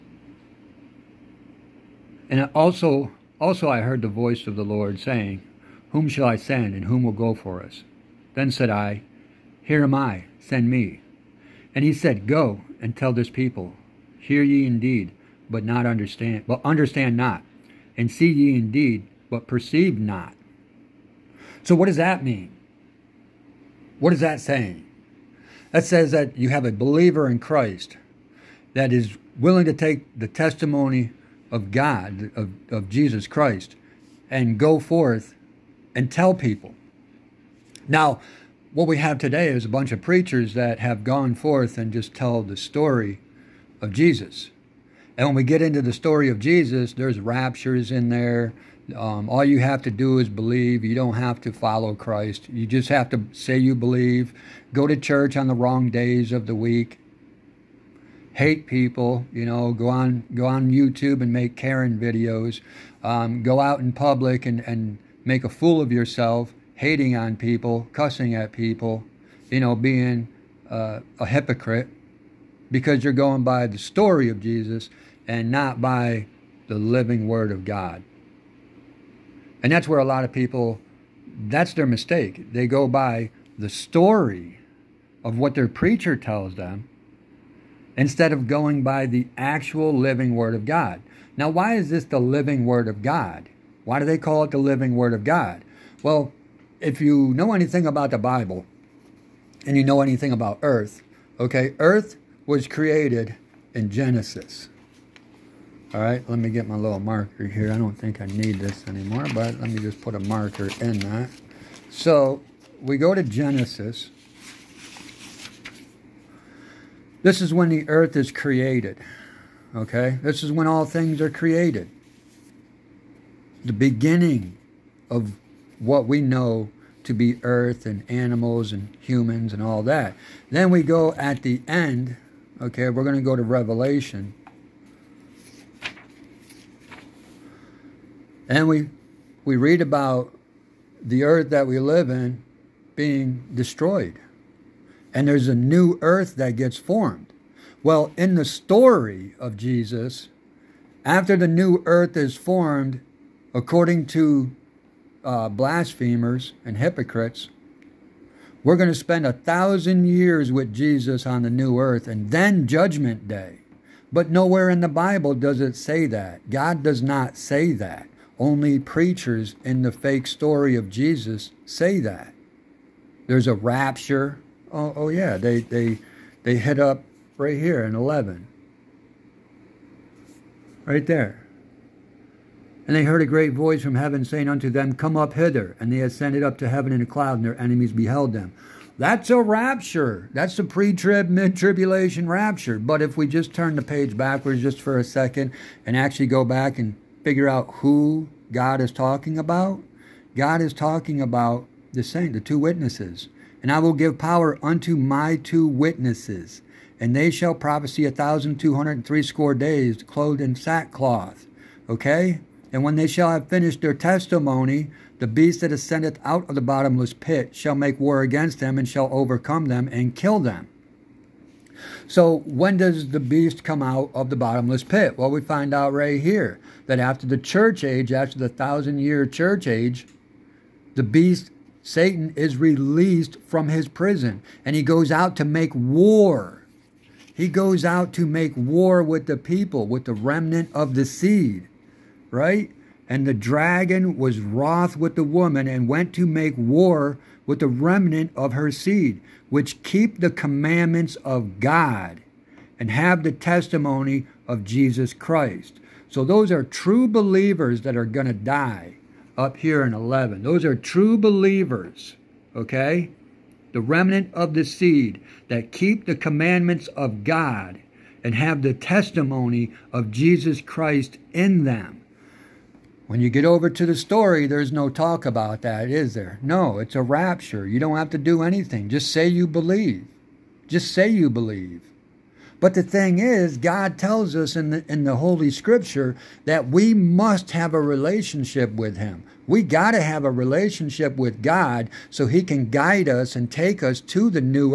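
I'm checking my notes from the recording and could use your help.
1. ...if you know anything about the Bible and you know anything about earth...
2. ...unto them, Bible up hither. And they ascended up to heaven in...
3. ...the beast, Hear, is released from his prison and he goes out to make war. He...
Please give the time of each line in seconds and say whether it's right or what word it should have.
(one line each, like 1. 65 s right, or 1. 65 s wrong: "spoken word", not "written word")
1. 96 s right
2. 184 s wrong: "Come", not "Bible"
3. 230 s wrong: "Satan", not "Hear".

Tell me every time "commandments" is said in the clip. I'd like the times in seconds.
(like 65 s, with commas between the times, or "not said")
250 s, 266 s.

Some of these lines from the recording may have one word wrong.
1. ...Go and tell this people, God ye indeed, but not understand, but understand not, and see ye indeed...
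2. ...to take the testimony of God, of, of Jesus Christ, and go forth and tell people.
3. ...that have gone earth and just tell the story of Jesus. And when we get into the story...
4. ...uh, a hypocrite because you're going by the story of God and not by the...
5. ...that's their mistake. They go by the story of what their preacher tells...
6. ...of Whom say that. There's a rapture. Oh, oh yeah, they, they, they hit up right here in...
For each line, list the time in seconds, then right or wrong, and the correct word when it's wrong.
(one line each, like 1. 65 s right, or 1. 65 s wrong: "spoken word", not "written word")
1. 12 s wrong: "Hear", not "God"
2. 29 s right
3. 40 s wrong: "forth", not "earth"
4. 70 s wrong: "Jesus", not "God"
5. 81 s right
6. 170 s wrong: "Jesus", not "Whom".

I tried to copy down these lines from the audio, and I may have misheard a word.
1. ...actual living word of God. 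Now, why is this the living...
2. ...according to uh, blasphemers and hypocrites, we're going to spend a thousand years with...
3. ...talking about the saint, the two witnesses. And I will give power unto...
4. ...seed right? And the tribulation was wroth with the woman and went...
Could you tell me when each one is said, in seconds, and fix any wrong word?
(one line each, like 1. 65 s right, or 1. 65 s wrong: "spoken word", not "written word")
1. 89 s right
2. 153 s right
3. 200 s right
4. 241 s wrong: "dragon", not "tribulation".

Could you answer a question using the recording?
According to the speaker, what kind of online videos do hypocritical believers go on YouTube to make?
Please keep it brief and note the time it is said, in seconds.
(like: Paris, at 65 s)
Karen videos, at 61 s.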